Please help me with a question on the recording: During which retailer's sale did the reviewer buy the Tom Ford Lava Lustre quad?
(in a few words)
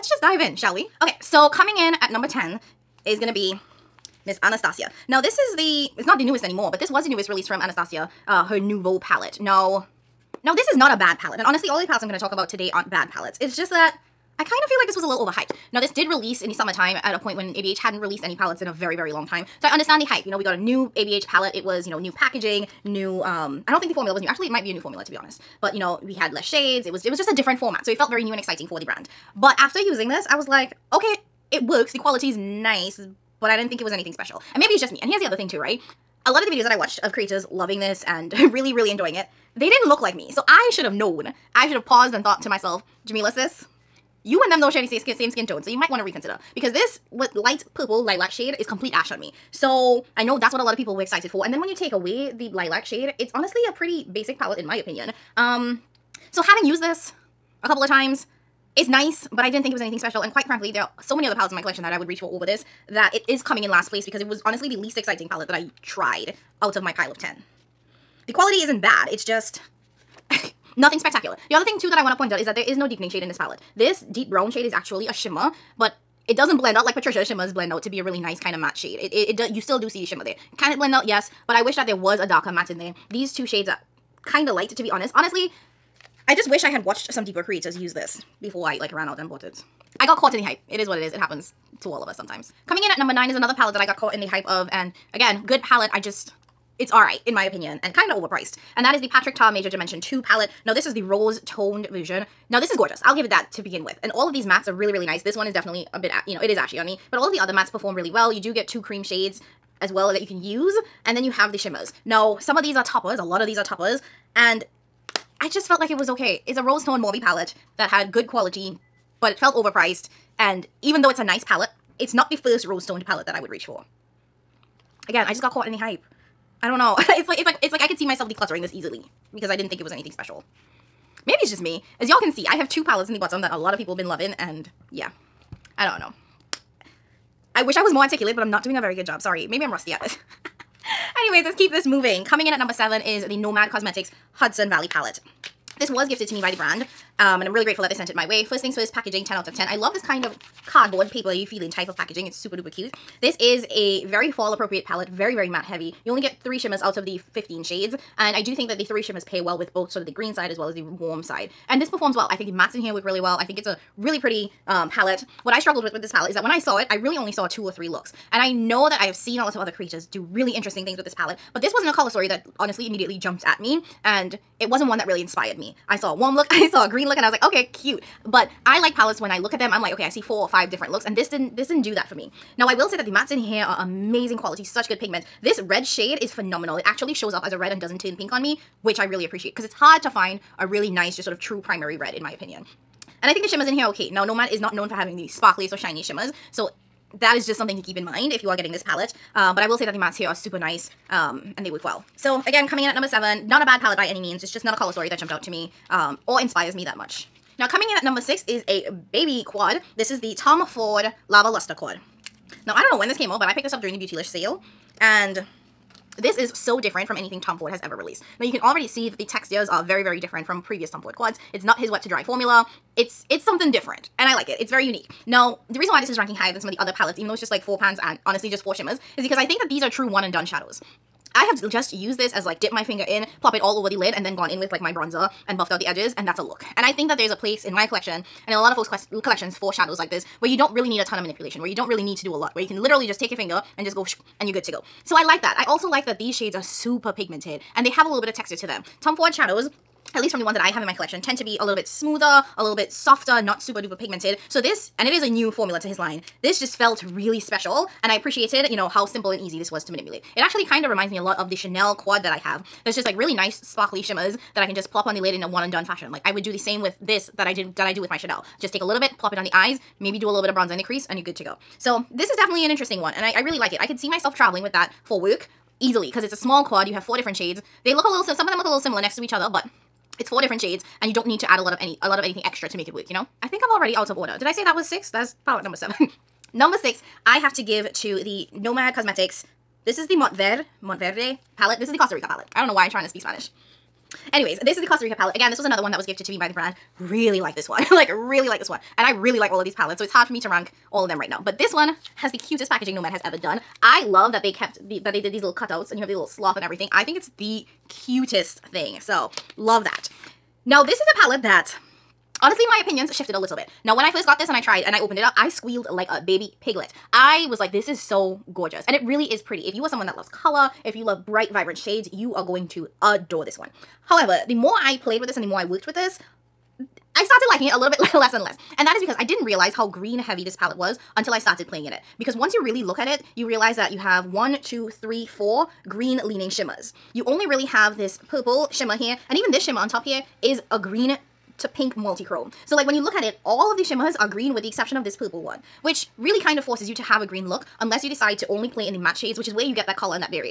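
Beautylish.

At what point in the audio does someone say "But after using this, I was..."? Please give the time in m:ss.
0:29.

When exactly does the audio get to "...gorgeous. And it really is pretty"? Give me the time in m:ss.
5:18.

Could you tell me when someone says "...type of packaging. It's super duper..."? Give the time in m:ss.
2:31.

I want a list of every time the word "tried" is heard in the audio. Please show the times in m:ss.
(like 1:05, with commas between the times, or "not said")
1:05, 5:14.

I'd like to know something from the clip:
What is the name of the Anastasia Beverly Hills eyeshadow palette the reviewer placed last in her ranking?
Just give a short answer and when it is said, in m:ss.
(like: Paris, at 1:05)
Nouveau, at 0:08.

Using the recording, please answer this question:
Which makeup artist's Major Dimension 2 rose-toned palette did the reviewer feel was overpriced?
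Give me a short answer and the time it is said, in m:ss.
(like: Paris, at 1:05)
Patrick Ta, at 1:39.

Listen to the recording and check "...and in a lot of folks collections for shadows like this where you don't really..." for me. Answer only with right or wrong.
right.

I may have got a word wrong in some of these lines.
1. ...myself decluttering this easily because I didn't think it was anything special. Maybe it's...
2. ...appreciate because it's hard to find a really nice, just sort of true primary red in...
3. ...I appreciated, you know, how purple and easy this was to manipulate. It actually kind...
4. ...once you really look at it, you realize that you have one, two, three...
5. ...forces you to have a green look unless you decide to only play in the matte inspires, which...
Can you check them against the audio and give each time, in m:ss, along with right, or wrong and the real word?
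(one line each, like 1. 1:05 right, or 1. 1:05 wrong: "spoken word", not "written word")
1. 2:08 right
2. 3:09 right
3. 4:18 wrong: "simple", not "purple"
4. 5:32 right
5. 5:46 wrong: "shades", not "inspires".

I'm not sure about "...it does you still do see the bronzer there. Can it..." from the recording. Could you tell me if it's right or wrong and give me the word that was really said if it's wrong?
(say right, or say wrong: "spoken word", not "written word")
wrong: "shimmer", not "bronzer".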